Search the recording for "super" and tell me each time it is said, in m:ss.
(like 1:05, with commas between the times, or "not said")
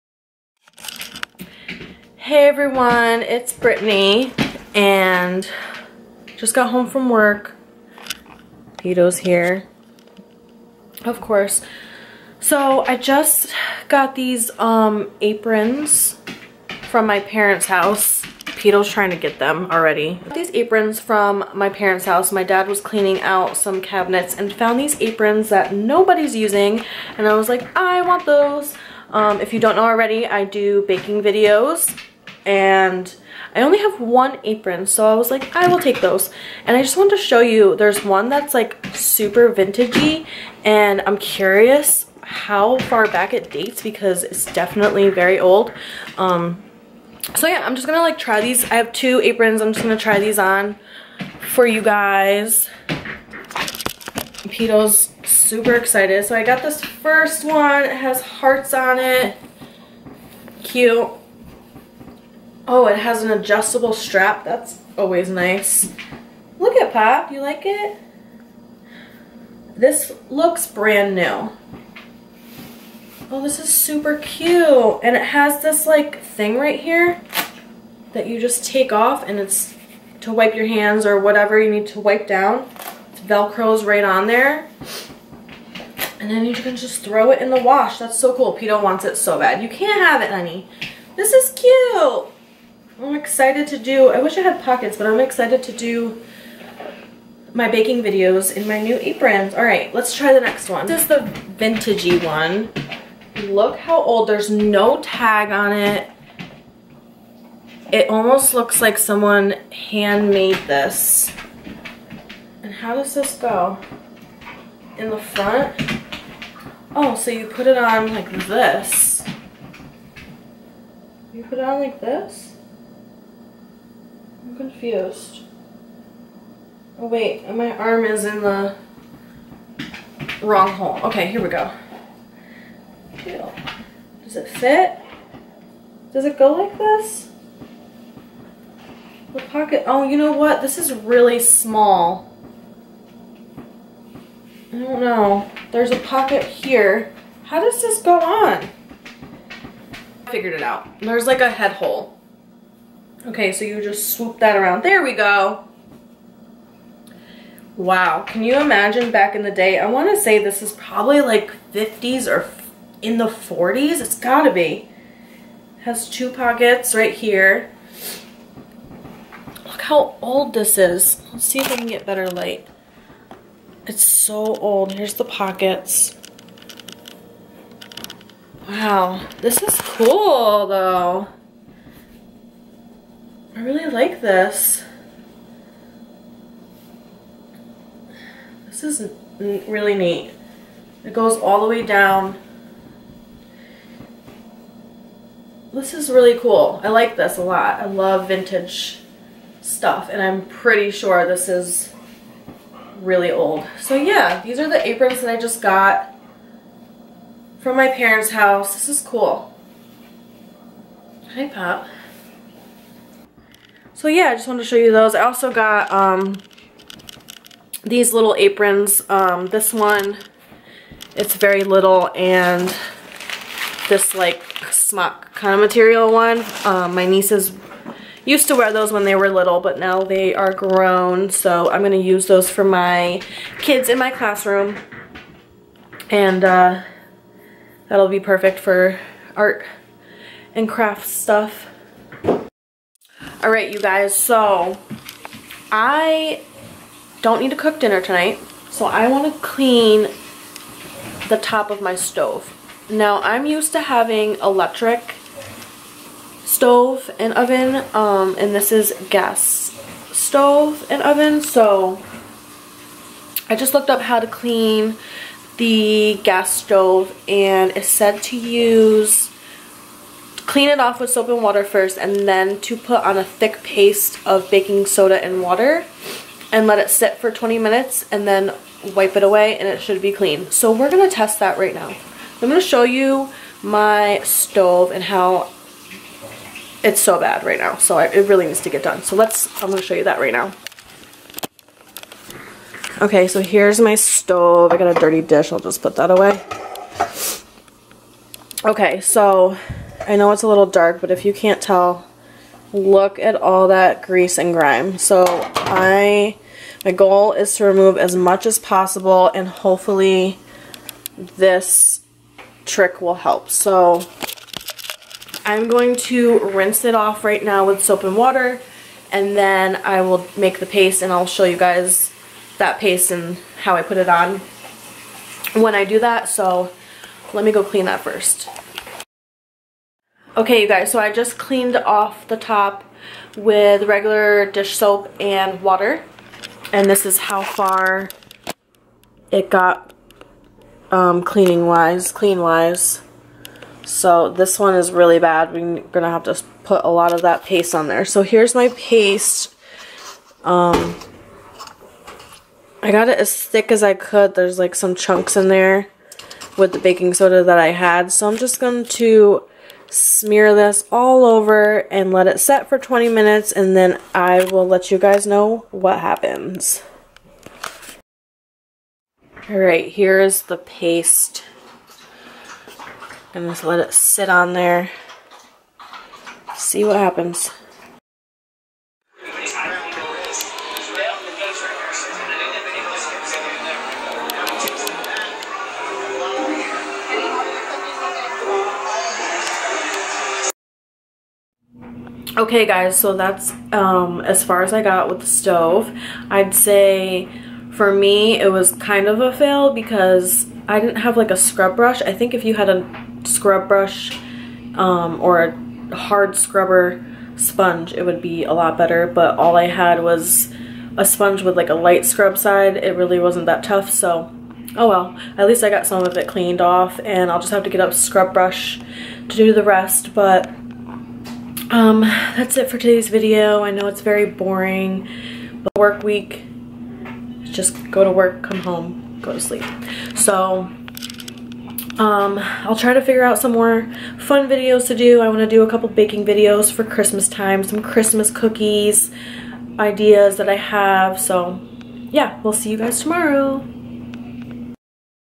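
0:38, 0:55, 1:13.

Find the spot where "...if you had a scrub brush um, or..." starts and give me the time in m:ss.
6:42.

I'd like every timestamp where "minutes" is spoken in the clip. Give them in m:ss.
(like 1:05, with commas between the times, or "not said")
4:37, 6:03.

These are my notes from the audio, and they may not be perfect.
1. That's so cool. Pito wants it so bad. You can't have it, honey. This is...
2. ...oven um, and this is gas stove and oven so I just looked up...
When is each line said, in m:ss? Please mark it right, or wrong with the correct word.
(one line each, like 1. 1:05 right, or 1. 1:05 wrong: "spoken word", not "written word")
1. 1:27 right
2. 4:17 right.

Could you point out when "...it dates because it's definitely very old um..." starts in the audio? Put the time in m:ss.
0:43.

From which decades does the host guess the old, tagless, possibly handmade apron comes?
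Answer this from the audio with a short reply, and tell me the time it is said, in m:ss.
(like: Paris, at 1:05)
50s or 40s, at 2:41.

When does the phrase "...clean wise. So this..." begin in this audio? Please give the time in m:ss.
5:42.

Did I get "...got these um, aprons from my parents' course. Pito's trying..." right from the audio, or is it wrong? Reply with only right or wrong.
wrong.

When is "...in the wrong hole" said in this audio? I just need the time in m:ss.
2:08.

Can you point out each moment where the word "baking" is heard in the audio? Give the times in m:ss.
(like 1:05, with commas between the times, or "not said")
0:30, 1:37, 4:34, 5:56, 7:15.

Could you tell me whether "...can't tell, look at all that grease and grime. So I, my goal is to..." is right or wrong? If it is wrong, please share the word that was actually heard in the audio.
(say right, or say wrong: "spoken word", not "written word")
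right.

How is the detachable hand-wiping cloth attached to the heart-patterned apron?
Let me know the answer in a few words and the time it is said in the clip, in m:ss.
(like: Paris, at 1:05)
Velcro, at 1:23.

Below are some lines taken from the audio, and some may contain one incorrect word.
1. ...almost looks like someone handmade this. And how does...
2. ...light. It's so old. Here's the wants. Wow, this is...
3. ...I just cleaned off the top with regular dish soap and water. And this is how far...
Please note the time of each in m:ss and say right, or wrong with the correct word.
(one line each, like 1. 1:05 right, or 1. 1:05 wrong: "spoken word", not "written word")
1. 1:48 right
2. 2:52 wrong: "pockets", not "wants"
3. 5:30 right.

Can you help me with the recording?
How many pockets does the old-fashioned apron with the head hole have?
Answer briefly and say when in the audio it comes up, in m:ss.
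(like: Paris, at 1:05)
2, at 2:46.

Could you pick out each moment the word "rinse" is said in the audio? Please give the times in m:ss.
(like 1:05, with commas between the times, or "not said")
5:16.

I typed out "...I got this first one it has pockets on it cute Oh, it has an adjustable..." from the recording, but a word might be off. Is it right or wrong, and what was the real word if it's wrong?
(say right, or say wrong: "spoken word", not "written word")
wrong: "hearts", not "pockets".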